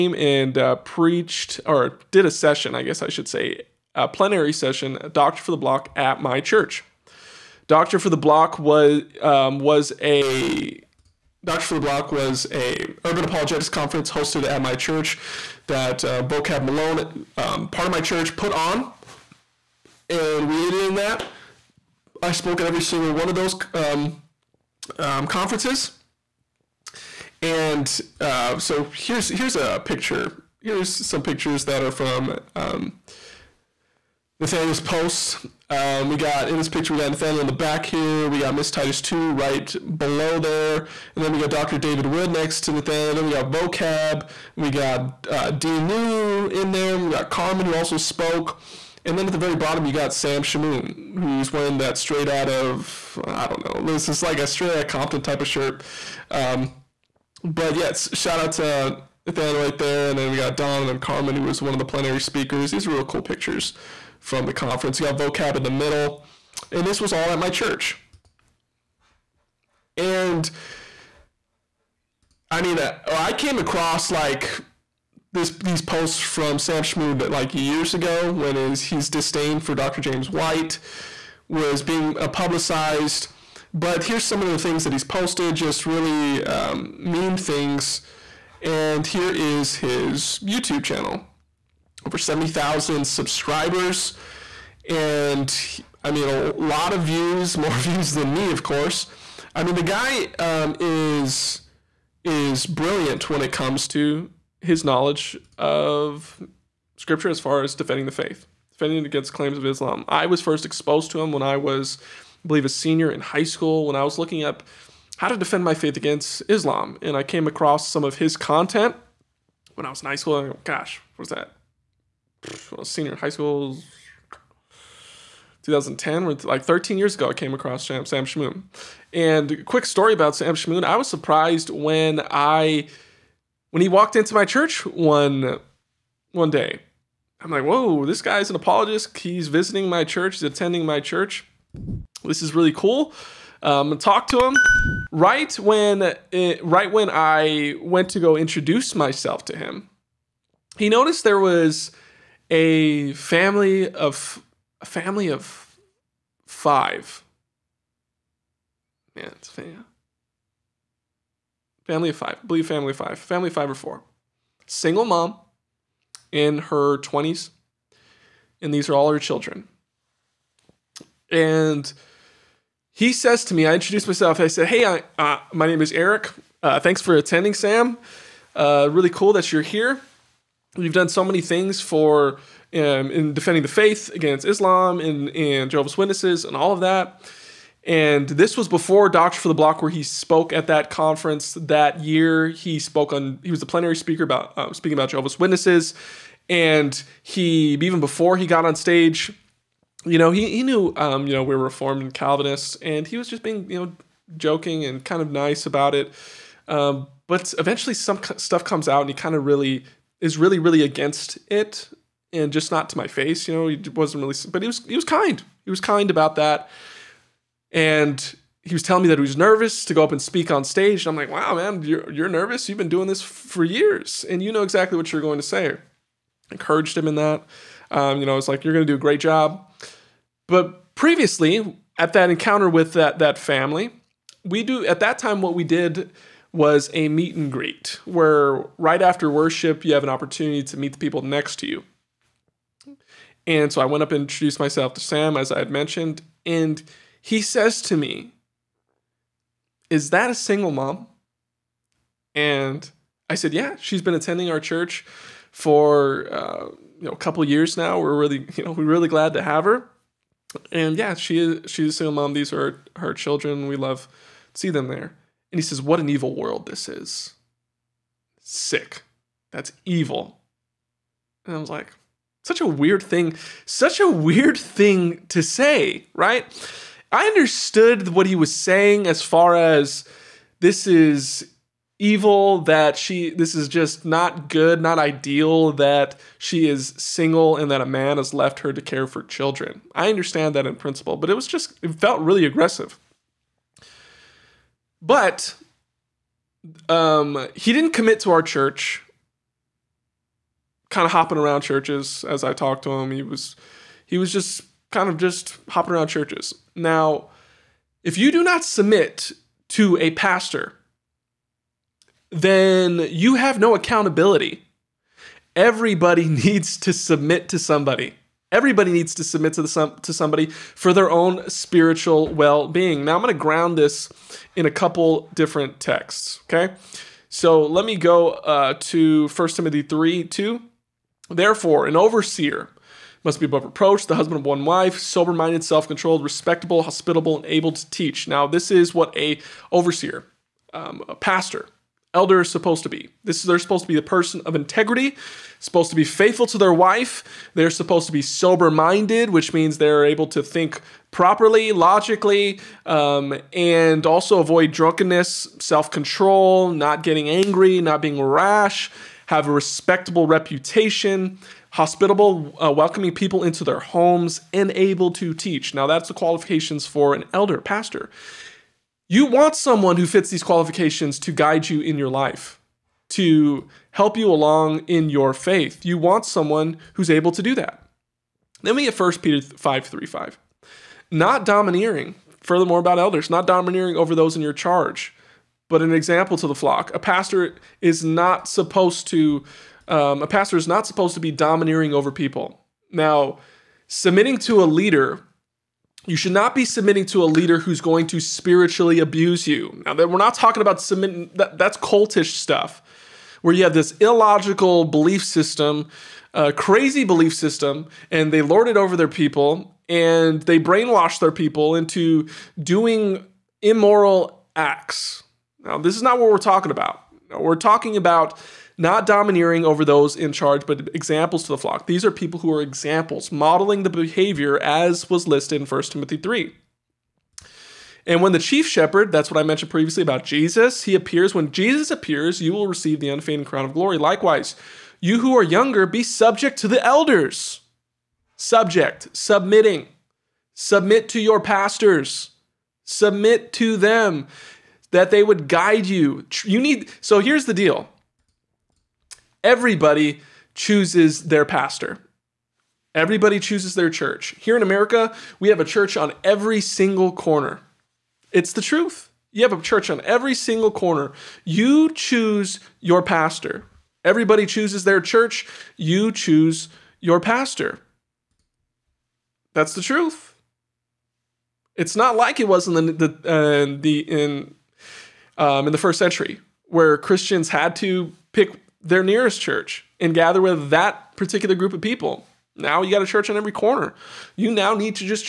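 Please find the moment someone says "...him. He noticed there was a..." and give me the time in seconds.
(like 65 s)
149 s.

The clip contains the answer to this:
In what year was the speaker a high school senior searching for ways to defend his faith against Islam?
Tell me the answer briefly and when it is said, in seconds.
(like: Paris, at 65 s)
2010, at 125 s.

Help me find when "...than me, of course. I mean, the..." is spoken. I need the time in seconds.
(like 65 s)
98 s.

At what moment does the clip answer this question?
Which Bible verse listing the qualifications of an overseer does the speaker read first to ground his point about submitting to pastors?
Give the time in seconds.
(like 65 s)
329 s.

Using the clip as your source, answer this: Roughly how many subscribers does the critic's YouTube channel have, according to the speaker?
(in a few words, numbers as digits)
Over 70,000.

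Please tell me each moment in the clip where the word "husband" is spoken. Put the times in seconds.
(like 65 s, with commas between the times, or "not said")
334 s.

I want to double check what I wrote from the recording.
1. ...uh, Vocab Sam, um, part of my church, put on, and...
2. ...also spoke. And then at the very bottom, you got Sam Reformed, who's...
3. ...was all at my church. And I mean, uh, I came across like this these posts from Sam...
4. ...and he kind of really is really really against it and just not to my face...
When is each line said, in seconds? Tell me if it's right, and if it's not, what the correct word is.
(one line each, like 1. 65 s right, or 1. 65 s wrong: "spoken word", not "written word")
1. 16 s wrong: "Malone", not "Sam"
2. 47 s wrong: "Shamoun", not "Reformed"
3. 66 s right
4. 209 s right.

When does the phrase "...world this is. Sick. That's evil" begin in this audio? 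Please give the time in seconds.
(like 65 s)
266 s.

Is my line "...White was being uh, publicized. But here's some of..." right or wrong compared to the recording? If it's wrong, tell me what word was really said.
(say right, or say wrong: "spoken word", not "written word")
right.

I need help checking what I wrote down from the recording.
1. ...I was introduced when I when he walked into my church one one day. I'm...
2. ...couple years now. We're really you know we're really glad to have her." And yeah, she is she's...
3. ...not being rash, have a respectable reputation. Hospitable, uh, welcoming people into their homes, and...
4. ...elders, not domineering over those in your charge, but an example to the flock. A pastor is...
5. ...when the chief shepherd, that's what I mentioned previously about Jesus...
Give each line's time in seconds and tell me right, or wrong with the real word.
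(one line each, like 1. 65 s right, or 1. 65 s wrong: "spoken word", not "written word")
1. 130 s wrong: "surprised", not "introduced"
2. 257 s right
3. 357 s right
4. 382 s right
5. 428 s right.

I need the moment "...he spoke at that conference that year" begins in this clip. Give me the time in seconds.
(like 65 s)
189 s.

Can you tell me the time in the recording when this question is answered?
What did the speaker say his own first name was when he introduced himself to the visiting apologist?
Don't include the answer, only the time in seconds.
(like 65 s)
175 s.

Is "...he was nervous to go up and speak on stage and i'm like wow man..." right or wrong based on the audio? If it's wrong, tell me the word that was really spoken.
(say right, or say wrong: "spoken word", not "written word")
right.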